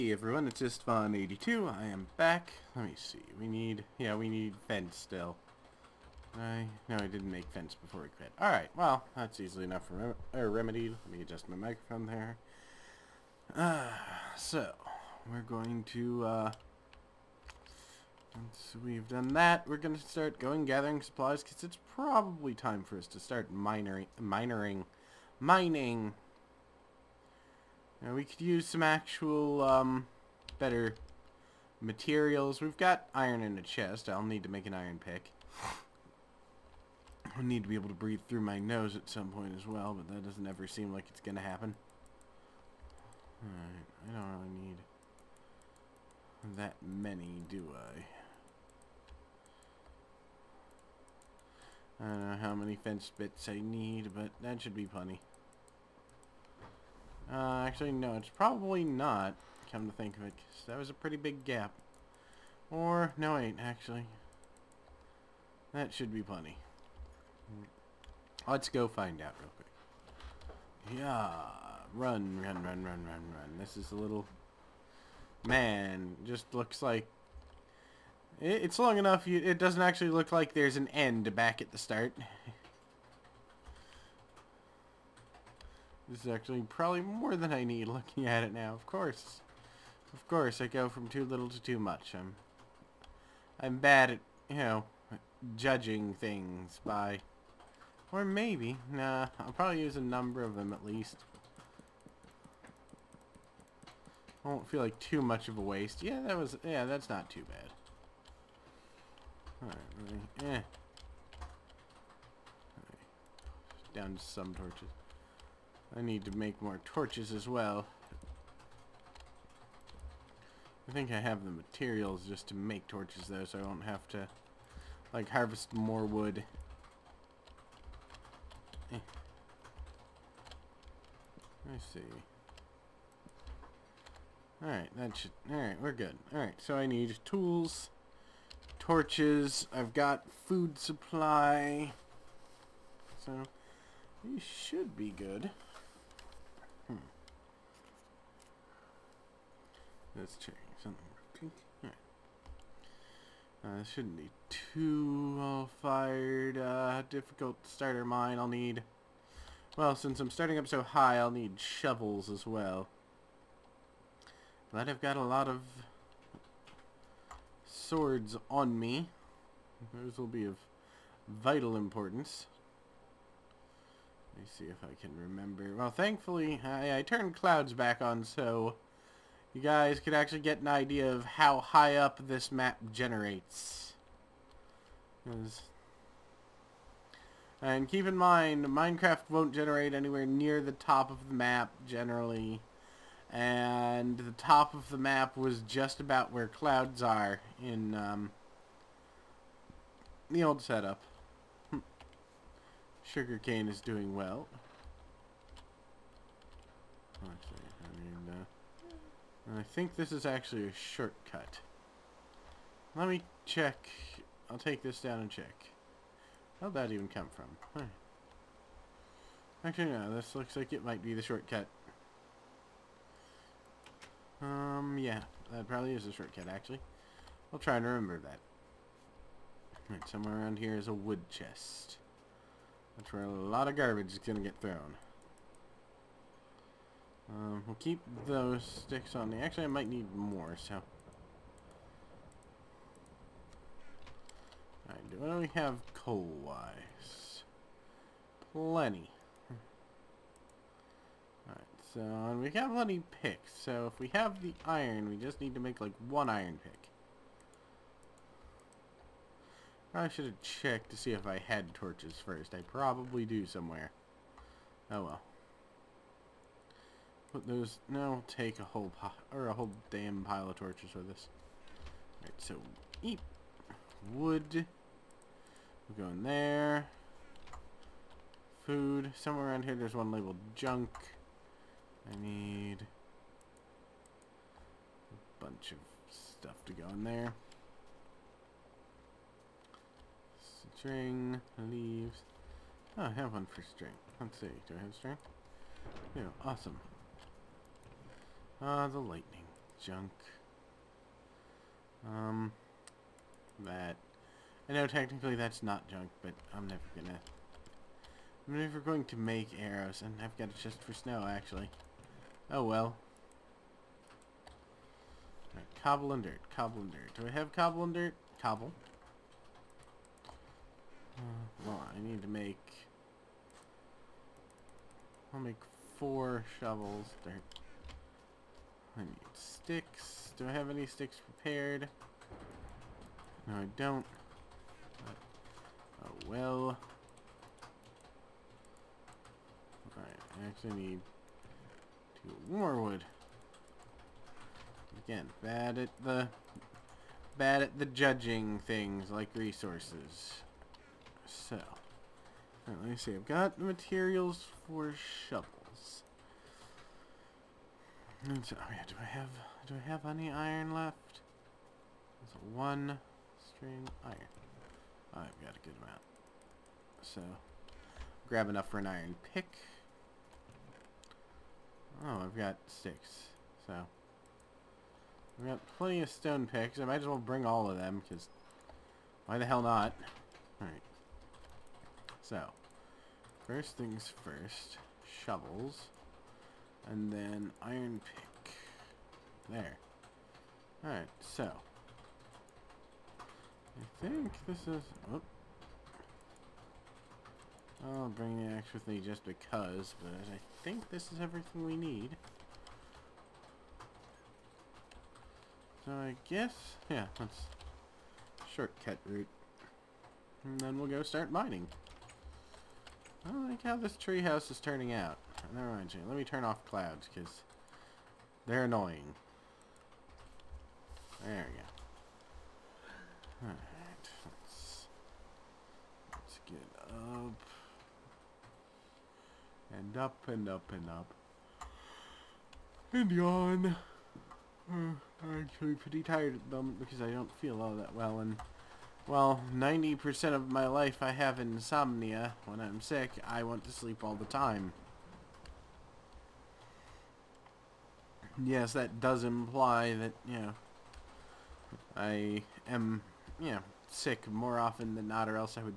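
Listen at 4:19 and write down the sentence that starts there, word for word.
I should have checked to see if I had torches first.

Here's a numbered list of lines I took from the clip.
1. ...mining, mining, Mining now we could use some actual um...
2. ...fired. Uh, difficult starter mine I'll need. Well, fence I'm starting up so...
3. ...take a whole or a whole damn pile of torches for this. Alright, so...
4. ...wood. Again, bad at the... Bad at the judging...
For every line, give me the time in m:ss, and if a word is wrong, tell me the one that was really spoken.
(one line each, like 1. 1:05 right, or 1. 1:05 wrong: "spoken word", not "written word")
1. 0:23 right
2. 2:35 wrong: "since", not "fence"
3. 4:28 right
4. 5:42 right.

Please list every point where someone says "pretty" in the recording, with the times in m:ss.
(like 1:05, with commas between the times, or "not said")
1:00, 7:15.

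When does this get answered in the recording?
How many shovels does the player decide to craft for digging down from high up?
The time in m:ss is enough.
5:25.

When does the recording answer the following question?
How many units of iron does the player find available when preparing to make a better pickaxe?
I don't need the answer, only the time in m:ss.
6:12.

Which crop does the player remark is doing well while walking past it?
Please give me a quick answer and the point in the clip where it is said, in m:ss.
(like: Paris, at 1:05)
Sugarcane, at 3:23.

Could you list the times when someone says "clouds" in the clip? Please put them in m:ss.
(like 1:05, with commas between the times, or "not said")
2:57, 3:16, 6:56.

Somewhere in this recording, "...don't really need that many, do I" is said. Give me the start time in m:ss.
0:44.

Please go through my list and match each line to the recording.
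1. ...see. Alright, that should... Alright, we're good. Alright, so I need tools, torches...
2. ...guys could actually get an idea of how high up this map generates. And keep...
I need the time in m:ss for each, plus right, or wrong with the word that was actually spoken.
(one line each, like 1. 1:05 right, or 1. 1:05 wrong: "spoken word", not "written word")
1. 2:11 right
2. 2:59 right.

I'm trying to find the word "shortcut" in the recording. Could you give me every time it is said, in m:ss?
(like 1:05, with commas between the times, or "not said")
3:30, 3:41, 3:46, 6:48.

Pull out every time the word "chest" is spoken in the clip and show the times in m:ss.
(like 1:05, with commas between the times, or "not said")
0:33, 3:51, 5:10.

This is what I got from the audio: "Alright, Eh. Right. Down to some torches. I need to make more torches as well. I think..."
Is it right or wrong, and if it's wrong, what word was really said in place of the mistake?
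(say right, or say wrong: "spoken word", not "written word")
right.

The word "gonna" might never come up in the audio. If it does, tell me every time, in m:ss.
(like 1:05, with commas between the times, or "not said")
5:06.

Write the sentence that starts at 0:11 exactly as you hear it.
Let me adjust my microphone there.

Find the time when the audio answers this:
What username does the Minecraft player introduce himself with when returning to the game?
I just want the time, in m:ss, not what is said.
0:00.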